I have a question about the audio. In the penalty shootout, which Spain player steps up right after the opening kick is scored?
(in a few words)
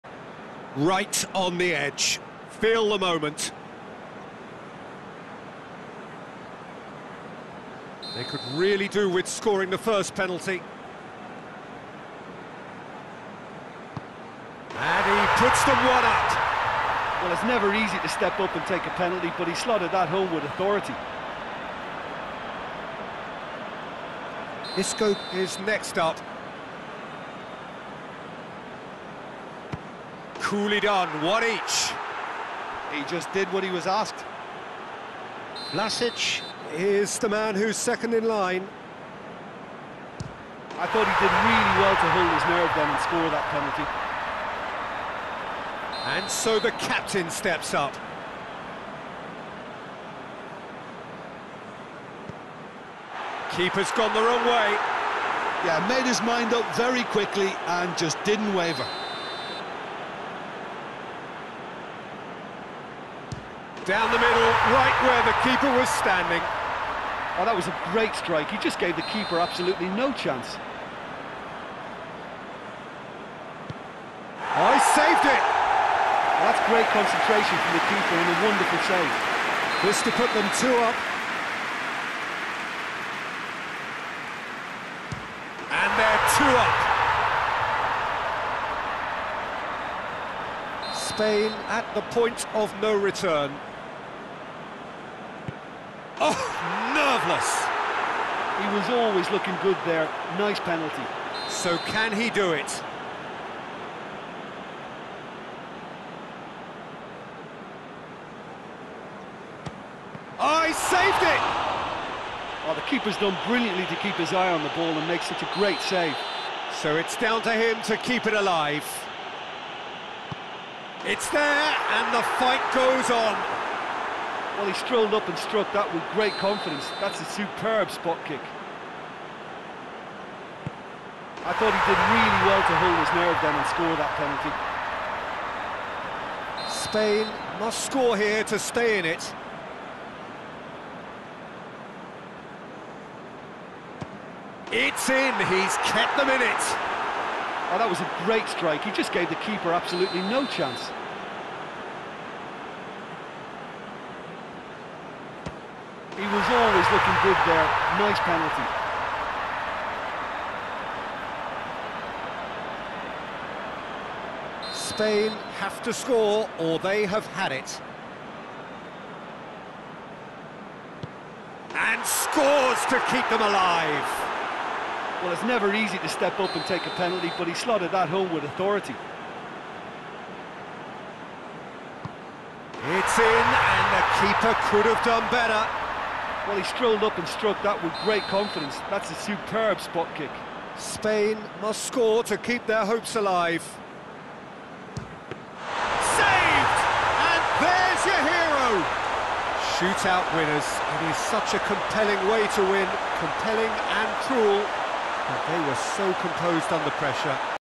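Isco.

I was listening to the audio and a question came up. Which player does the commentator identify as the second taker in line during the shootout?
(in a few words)
Vlasic.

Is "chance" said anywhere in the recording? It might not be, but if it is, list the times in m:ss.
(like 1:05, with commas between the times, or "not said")
1:10, 2:30.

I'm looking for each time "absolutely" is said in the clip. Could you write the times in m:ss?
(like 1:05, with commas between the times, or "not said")
1:09, 2:29.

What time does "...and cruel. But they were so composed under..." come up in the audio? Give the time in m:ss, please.
3:24.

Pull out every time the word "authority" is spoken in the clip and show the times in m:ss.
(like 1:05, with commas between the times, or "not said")
0:20, 2:58.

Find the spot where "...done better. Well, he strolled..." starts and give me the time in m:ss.
3:05.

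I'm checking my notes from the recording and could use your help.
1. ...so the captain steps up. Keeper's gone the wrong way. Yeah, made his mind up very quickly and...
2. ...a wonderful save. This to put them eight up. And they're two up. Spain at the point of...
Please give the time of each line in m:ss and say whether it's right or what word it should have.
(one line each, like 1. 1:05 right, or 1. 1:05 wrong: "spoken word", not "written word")
1. 0:46 right
2. 1:18 wrong: "two", not "eight".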